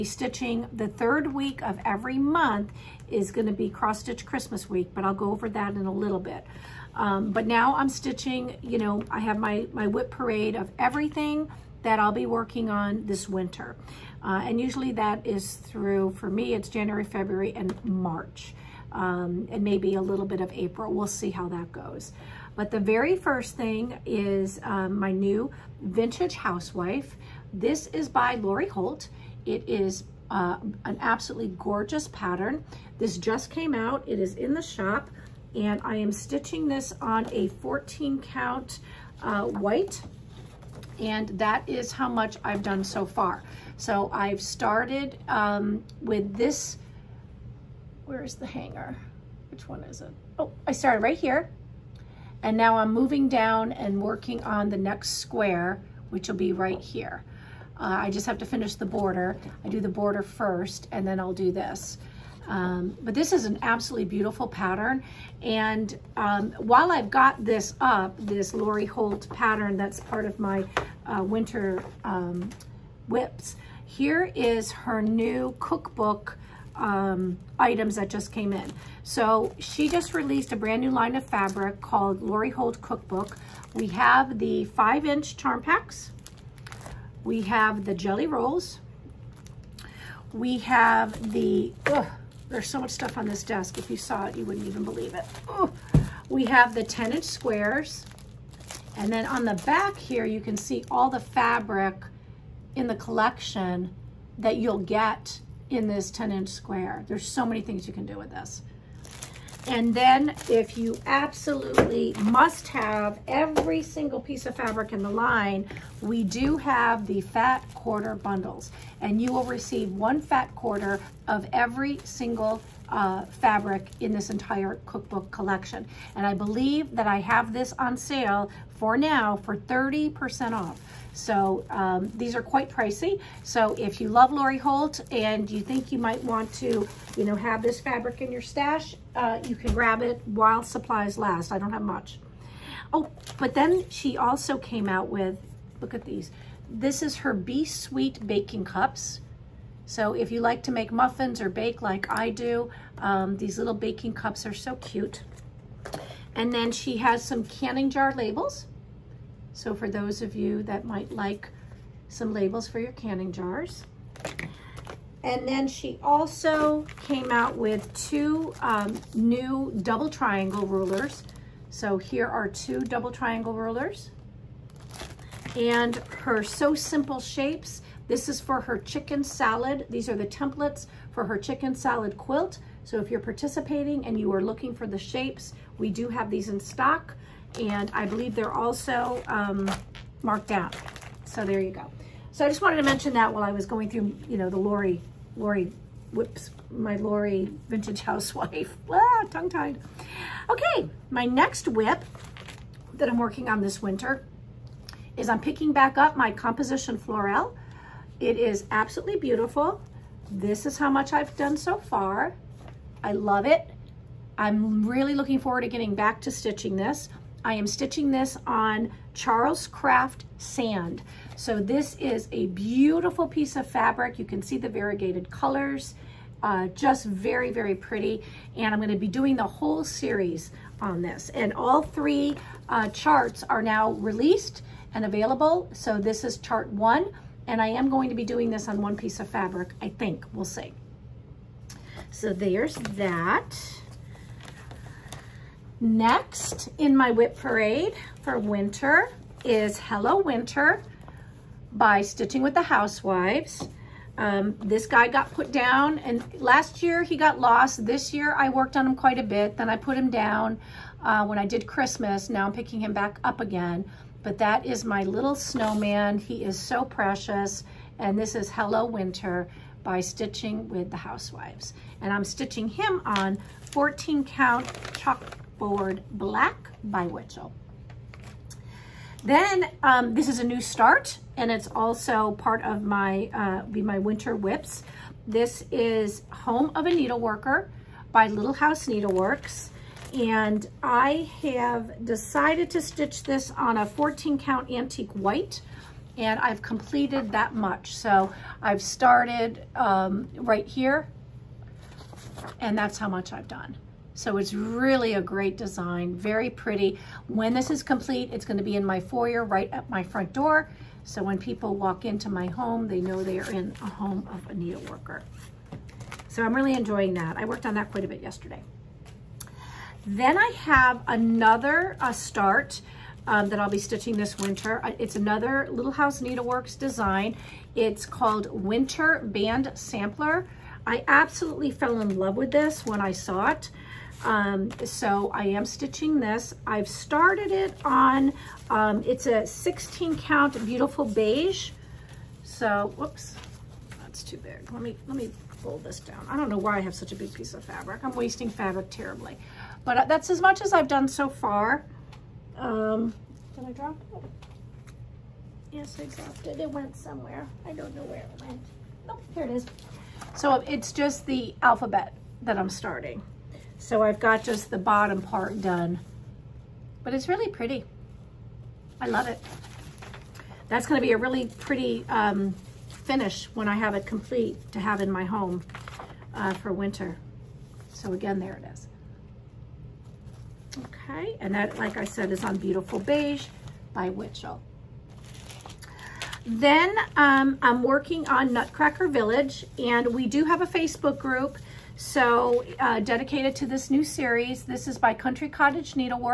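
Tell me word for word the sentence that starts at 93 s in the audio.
If you saw it, you wouldn't even believe it.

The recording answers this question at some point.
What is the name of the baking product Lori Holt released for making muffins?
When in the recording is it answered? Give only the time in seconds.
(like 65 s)
147 s.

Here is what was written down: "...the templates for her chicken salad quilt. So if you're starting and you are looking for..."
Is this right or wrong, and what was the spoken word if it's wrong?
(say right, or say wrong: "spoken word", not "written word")
wrong: "participating", not "starting".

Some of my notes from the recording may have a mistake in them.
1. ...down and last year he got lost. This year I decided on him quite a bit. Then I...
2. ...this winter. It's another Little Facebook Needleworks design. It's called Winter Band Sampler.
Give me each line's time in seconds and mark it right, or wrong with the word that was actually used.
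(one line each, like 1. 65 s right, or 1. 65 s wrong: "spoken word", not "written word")
1. 255 s wrong: "worked", not "decided"
2. 324 s wrong: "House", not "Facebook".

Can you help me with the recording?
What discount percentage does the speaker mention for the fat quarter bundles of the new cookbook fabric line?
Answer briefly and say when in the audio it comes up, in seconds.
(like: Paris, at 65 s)
30%, at 129 s.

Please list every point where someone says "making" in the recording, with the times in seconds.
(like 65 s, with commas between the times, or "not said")
not said.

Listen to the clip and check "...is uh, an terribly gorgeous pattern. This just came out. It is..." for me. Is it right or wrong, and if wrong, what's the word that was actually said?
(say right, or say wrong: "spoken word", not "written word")
wrong: "absolutely", not "terribly".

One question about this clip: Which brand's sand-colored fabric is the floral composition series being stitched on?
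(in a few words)
Charles Craft.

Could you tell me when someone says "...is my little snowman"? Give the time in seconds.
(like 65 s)
264 s.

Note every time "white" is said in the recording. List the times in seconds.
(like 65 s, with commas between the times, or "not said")
39 s, 295 s.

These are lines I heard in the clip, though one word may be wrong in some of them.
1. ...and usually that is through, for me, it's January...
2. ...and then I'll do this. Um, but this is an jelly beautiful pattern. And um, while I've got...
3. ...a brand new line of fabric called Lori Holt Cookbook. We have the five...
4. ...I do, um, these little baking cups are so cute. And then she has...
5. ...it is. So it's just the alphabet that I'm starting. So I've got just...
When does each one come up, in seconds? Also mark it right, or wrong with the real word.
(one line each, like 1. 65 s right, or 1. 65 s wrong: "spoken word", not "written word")
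1. 14 s right
2. 60 s wrong: "absolutely", not "jelly"
3. 80 s right
4. 152 s right
5. 359 s right.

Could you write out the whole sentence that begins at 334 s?
Um, so I am stitching this.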